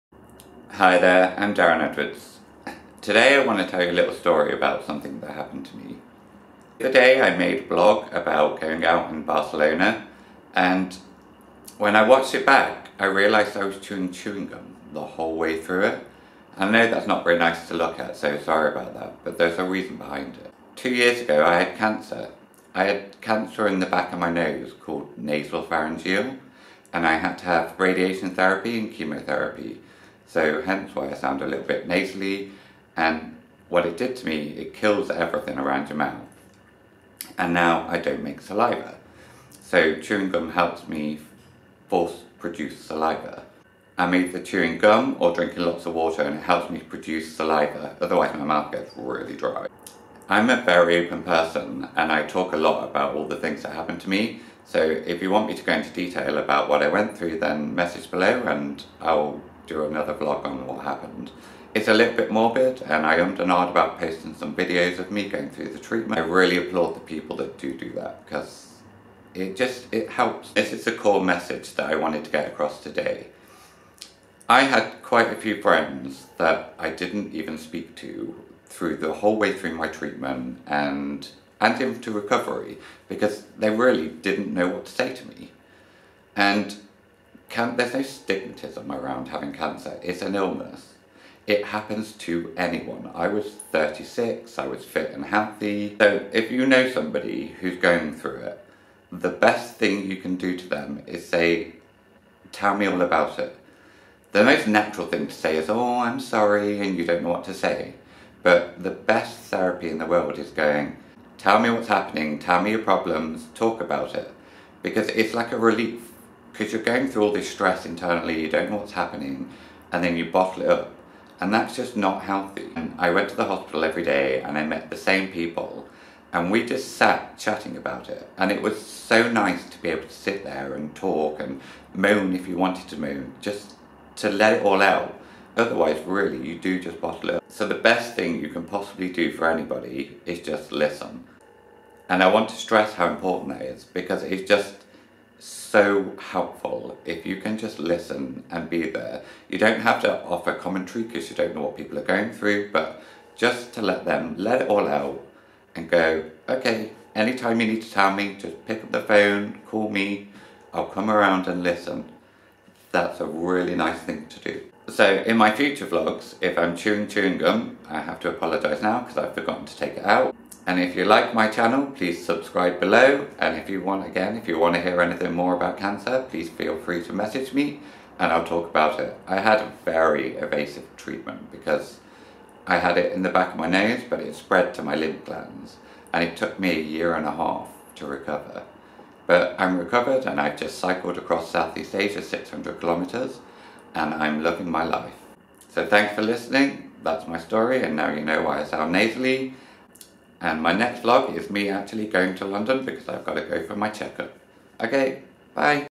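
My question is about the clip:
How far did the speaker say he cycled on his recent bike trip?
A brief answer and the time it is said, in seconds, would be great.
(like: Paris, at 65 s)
600 kilometres, at 192 s.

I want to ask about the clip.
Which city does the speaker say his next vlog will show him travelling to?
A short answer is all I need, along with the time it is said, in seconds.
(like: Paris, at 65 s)
London, at 202 s.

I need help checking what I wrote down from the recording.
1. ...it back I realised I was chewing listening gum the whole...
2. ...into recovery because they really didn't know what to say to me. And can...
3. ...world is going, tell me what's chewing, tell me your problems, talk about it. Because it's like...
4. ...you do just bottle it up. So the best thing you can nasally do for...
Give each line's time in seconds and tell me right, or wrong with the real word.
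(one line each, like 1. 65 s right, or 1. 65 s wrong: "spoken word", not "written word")
1. 12 s wrong: "chewing", not "listening"
2. 81 s right
3. 110 s wrong: "happening", not "chewing"
4. 136 s wrong: "possibly", not "nasally".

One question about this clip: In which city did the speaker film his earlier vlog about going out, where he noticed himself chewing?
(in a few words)
Barcelona.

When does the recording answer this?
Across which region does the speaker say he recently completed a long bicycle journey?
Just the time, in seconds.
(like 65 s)
191 s.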